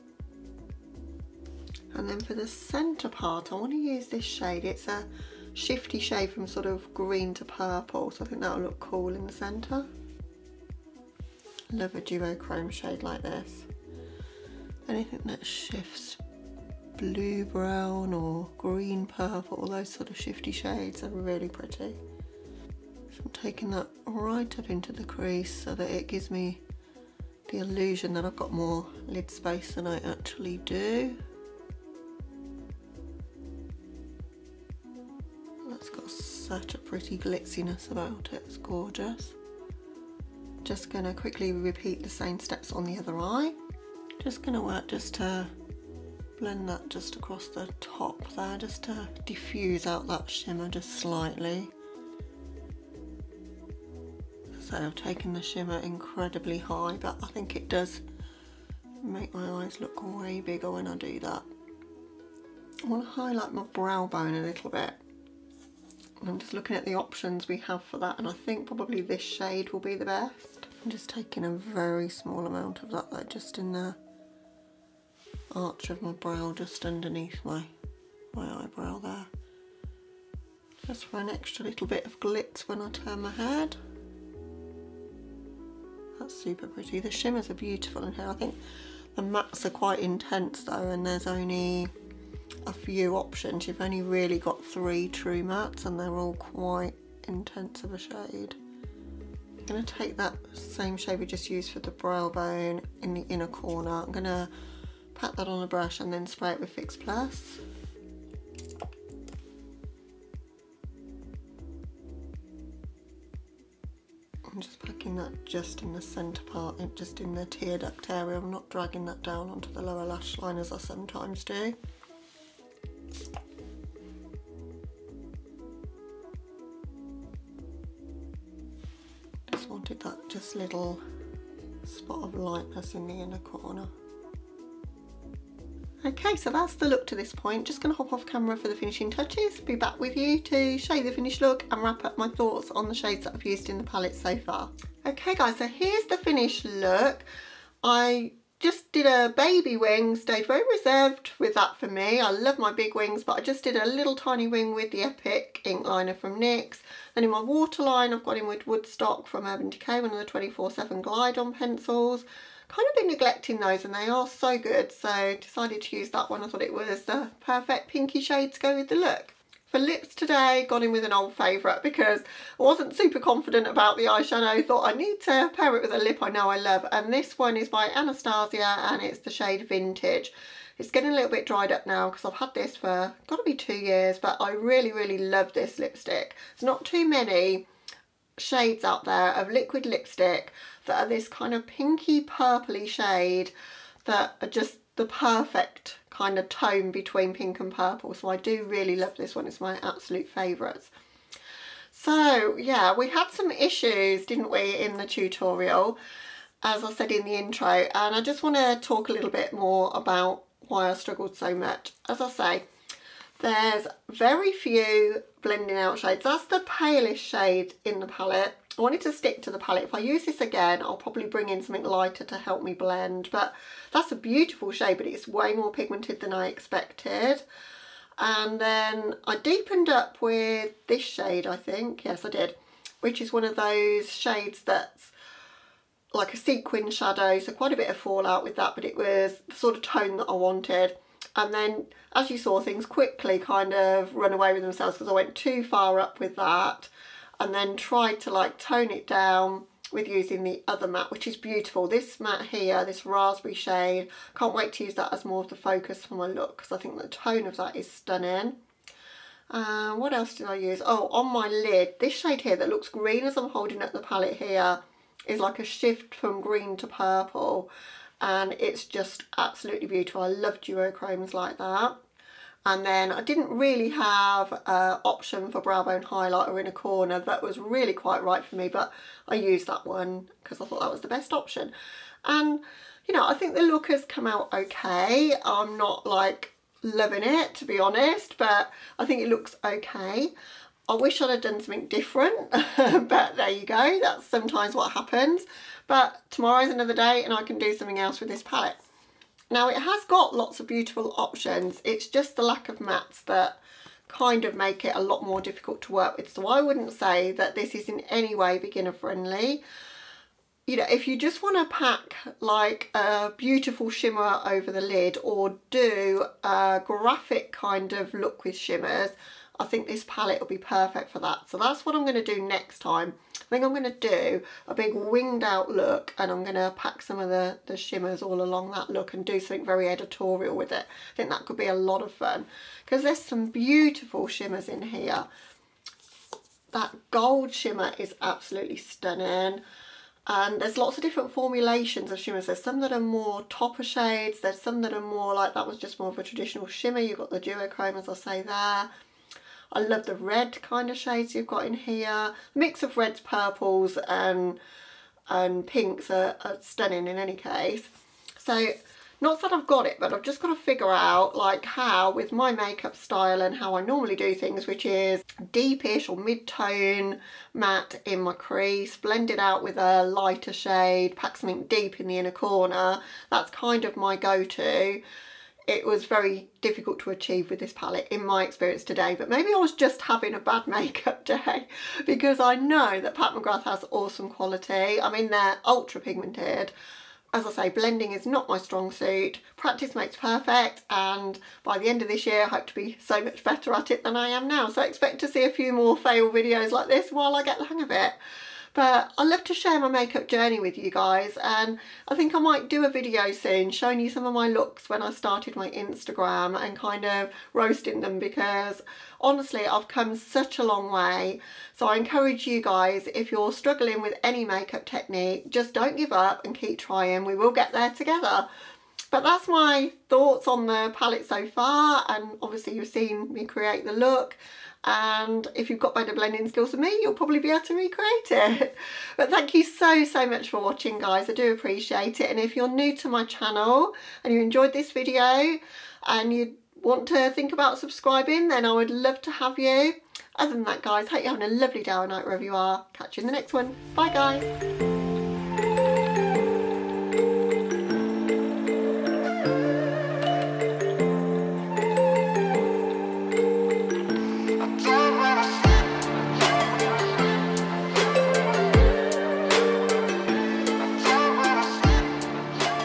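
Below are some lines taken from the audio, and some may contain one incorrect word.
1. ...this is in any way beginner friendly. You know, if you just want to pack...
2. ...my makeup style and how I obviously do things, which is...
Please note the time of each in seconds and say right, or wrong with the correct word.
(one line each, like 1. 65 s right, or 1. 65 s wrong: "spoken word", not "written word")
1. 307 s right
2. 362 s wrong: "normally", not "obviously".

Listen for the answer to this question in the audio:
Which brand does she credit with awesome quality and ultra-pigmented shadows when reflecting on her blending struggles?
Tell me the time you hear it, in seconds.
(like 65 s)
383 s.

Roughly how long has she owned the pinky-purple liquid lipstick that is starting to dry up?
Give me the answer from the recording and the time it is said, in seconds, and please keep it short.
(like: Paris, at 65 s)
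2 years, at 183 s.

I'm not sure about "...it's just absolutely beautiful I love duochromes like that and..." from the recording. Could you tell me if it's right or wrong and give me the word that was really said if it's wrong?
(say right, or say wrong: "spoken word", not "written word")
right.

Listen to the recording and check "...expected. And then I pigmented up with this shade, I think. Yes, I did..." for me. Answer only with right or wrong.
wrong.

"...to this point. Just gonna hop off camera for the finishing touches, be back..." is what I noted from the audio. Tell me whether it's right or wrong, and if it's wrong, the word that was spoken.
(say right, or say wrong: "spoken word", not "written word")
right.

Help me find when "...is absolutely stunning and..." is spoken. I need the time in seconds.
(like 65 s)
337 s.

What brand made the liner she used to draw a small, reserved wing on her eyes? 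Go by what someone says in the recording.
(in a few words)
NYX.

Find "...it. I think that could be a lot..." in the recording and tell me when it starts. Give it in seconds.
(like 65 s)
330 s.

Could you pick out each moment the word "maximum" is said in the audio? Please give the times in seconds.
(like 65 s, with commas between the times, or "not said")
not said.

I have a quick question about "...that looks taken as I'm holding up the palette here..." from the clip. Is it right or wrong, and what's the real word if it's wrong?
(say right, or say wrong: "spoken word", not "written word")
wrong: "green", not "taken".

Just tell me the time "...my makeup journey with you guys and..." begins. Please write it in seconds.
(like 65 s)
399 s.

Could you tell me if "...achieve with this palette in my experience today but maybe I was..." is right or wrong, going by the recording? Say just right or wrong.
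right.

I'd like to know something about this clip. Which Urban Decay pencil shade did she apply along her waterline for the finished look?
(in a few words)
Woodstock.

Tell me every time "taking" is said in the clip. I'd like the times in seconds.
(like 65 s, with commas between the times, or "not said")
23 s, 71 s.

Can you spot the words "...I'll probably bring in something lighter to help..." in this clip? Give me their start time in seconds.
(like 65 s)
220 s.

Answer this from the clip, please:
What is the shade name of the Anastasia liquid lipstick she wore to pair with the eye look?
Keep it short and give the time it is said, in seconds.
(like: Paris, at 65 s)
Vintage, at 179 s.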